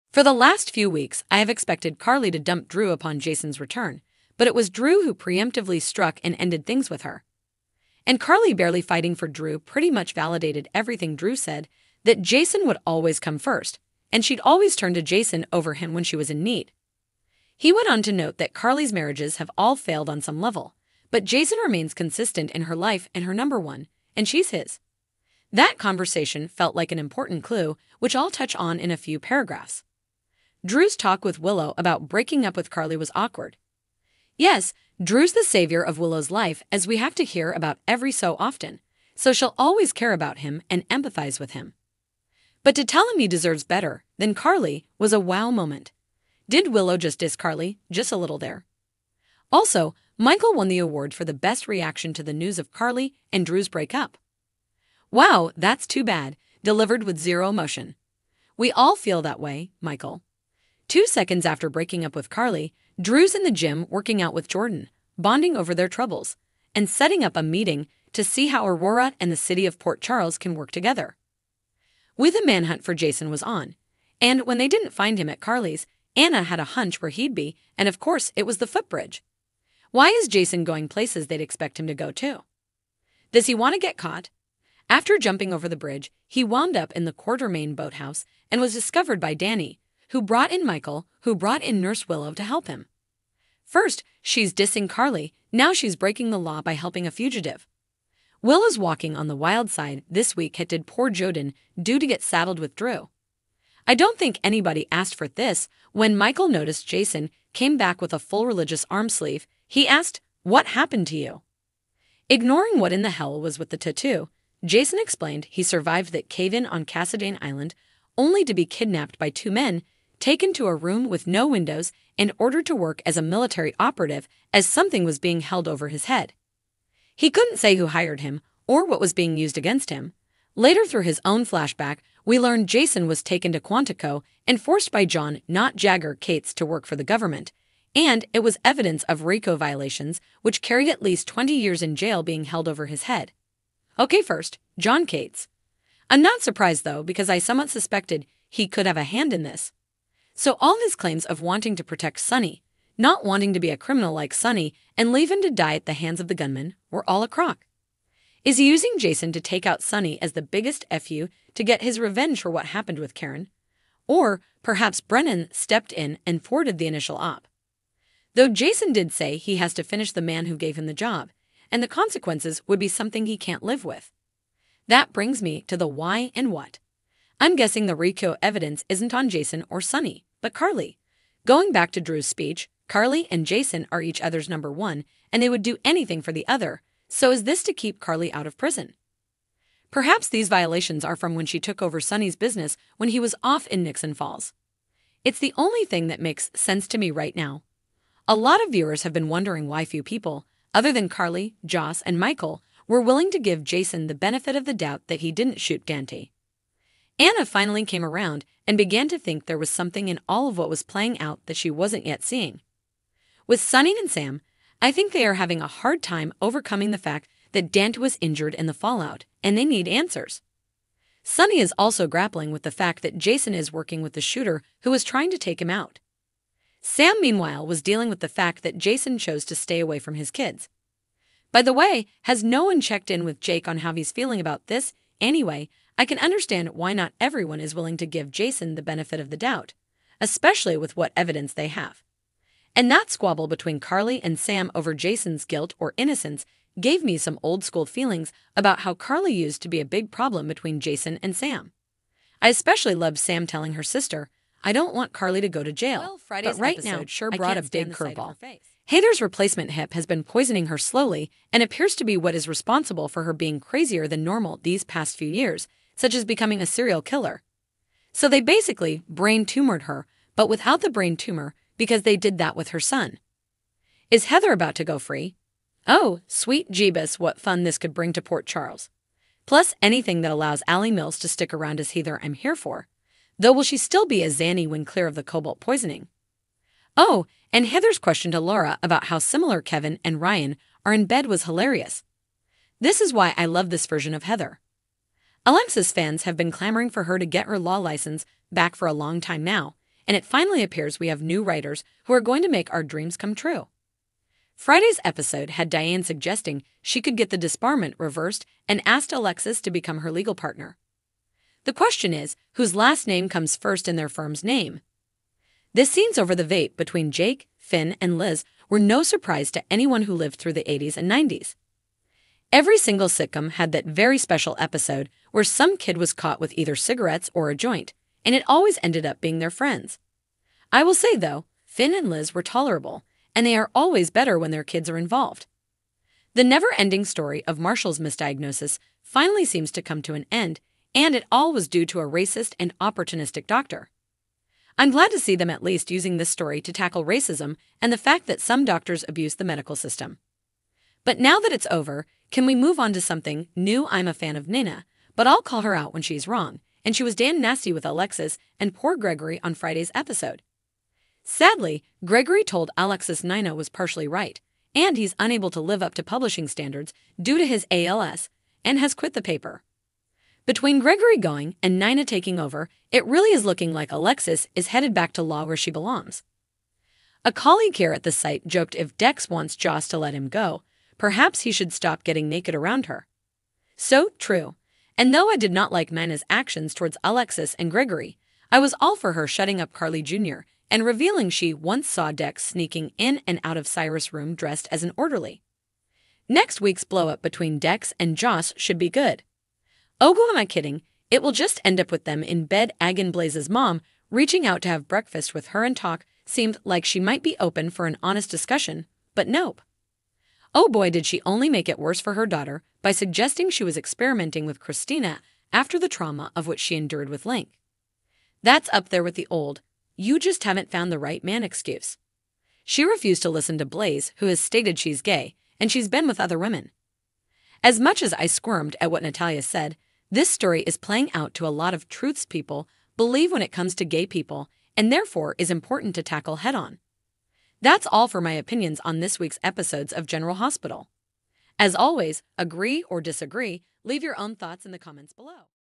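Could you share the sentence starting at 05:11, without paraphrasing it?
The question is whose last name comes first in their firm's name?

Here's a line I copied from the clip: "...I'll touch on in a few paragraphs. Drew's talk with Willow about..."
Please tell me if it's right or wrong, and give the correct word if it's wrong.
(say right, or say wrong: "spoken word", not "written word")
right.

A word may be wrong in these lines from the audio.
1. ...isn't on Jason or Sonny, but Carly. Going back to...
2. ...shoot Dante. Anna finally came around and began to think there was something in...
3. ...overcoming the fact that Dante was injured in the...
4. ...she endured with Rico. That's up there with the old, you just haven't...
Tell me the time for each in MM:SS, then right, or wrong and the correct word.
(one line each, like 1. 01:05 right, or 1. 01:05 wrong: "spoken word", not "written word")
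1. 02:58 right
2. 03:25 right
3. 03:36 right
4. 06:56 wrong: "Link", not "Rico".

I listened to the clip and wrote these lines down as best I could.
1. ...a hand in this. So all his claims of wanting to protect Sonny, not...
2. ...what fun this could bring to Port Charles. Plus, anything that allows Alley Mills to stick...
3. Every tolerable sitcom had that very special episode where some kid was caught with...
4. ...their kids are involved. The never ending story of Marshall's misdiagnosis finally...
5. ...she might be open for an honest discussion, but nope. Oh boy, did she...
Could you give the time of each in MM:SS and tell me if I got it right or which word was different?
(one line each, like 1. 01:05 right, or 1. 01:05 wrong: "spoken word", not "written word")
1. 02:28 right
2. 04:37 right
3. 05:22 wrong: "single", not "tolerable"
4. 05:34 right
5. 06:46 right.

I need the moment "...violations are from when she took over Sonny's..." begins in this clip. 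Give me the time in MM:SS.
03:10.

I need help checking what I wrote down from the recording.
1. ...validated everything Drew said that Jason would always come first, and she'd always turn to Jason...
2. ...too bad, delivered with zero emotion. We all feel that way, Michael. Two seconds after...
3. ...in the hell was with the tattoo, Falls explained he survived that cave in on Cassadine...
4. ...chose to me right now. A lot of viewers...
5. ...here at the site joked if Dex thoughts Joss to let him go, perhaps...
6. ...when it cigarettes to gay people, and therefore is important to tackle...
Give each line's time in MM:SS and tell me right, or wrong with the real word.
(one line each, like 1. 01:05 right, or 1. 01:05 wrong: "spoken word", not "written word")
1. 00:10 right
2. 00:55 right
3. 01:52 wrong: "Jason", not "Falls"
4. 03:16 wrong: "sense", not "chose"
5. 06:17 wrong: "wants", not "thoughts"
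6. 07:13 wrong: "comes", not "cigarettes".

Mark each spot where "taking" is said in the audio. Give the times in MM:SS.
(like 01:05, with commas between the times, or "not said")
06:12.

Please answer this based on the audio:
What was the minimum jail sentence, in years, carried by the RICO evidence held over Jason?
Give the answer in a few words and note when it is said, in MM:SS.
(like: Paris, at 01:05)
20, at 02:21.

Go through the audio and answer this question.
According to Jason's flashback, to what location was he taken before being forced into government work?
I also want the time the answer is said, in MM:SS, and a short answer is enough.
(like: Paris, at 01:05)
Quantico, at 02:13.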